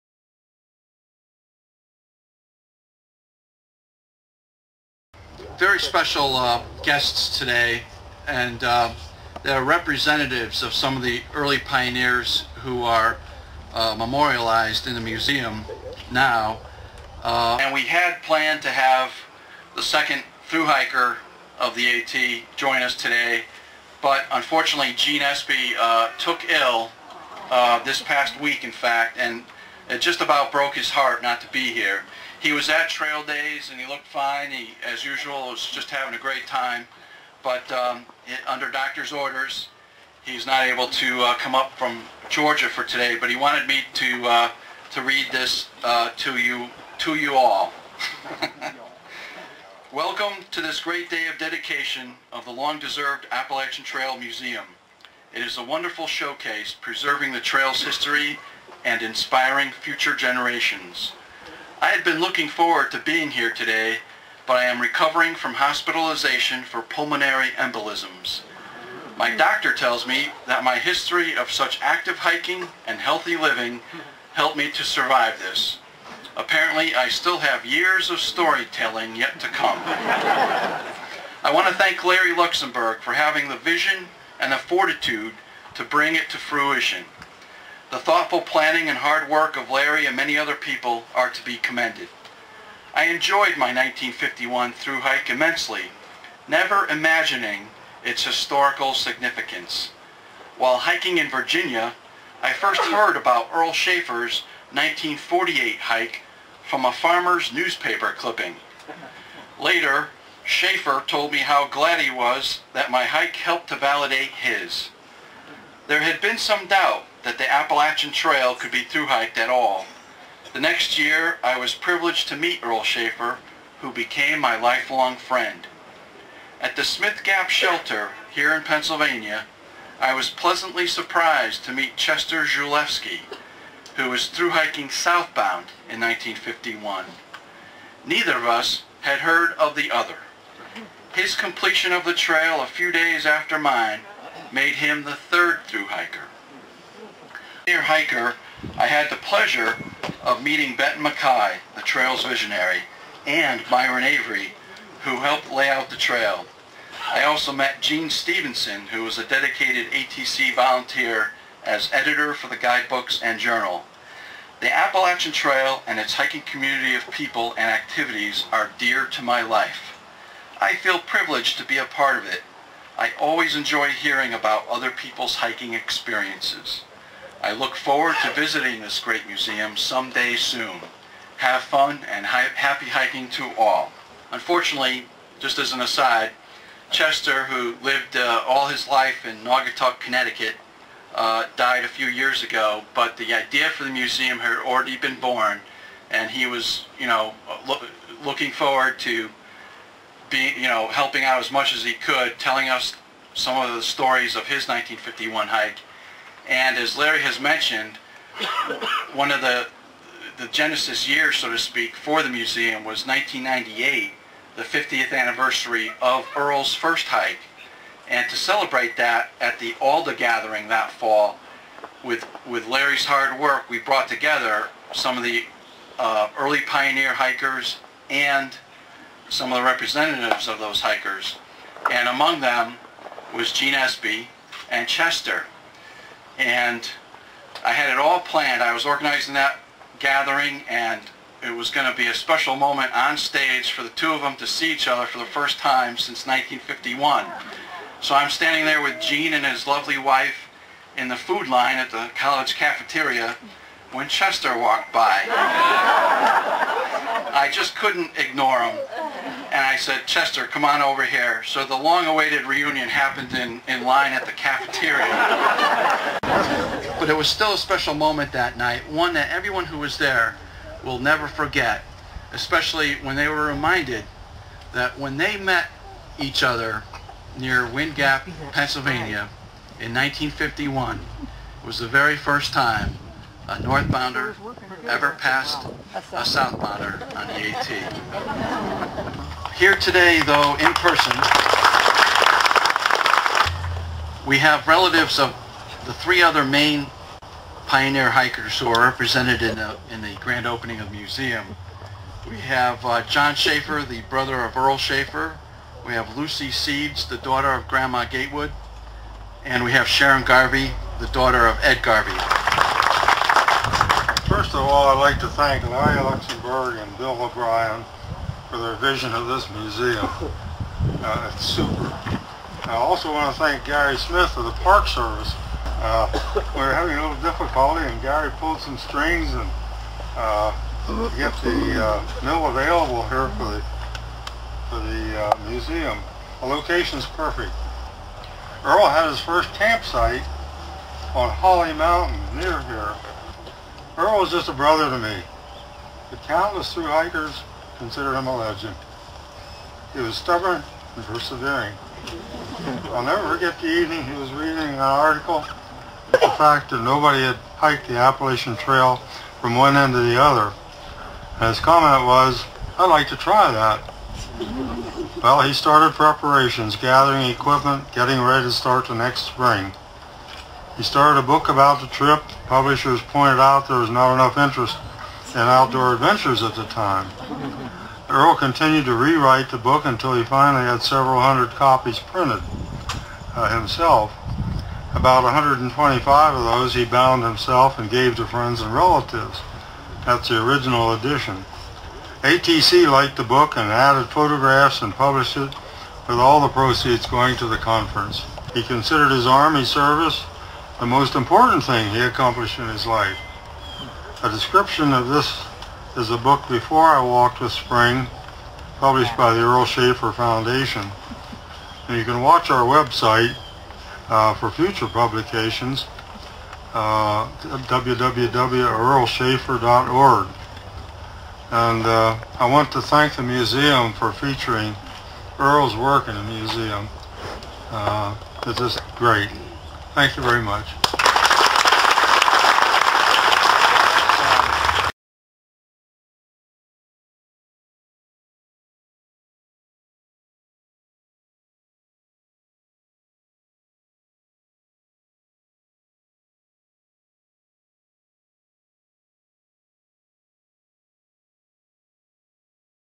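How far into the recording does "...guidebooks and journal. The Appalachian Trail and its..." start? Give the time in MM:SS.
02:42.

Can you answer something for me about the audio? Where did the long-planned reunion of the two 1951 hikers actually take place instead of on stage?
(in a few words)
College cafeteria.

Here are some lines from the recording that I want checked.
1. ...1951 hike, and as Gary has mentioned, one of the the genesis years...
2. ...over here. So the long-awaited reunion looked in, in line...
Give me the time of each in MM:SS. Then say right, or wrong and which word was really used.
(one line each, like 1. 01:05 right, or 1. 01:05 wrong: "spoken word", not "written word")
1. 03:24 wrong: "Larry", not "Gary"
2. 04:20 wrong: "happened", not "looked".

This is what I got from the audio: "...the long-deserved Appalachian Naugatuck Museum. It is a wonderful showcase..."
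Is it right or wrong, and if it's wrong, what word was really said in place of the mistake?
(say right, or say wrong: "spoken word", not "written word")
wrong: "Trail", not "Naugatuck".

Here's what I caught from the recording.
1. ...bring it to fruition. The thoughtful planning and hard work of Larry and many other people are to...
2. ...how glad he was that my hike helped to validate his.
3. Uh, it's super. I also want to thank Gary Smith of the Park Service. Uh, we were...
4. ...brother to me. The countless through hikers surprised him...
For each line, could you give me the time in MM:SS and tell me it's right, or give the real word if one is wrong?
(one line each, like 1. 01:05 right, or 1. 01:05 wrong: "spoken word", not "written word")
1. 01:25 right
2. 01:51 right
3. 05:21 right
4. 05:44 wrong: "considered", not "surprised".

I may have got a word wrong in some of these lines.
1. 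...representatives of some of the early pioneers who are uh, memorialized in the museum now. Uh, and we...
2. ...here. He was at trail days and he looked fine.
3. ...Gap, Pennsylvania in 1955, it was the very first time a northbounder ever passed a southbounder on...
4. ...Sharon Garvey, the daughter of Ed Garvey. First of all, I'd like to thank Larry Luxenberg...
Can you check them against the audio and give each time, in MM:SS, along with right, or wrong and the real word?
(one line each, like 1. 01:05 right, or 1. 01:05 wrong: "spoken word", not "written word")
1. 00:09 right
2. 00:31 right
3. 04:37 wrong: "1951", not "1955"
4. 05:09 right.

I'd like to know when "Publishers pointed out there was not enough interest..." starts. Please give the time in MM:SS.
06:12.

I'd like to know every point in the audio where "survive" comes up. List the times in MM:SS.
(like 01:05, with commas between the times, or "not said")
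01:14.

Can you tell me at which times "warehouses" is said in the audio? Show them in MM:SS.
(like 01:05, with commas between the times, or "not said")
not said.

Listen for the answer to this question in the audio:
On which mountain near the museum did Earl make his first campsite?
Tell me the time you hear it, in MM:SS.
05:41.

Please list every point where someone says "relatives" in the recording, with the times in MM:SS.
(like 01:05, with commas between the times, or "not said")
04:54, 06:28.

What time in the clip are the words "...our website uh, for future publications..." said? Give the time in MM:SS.
06:52.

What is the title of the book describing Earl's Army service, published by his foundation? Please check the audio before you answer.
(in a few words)
Before I Walked with Spring.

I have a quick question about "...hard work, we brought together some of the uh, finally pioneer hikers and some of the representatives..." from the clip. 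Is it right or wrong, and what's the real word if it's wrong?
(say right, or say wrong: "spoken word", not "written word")
wrong: "early", not "finally".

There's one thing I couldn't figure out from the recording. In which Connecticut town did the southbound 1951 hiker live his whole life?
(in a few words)
Naugatuck.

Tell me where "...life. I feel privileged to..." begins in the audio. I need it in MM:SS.
02:49.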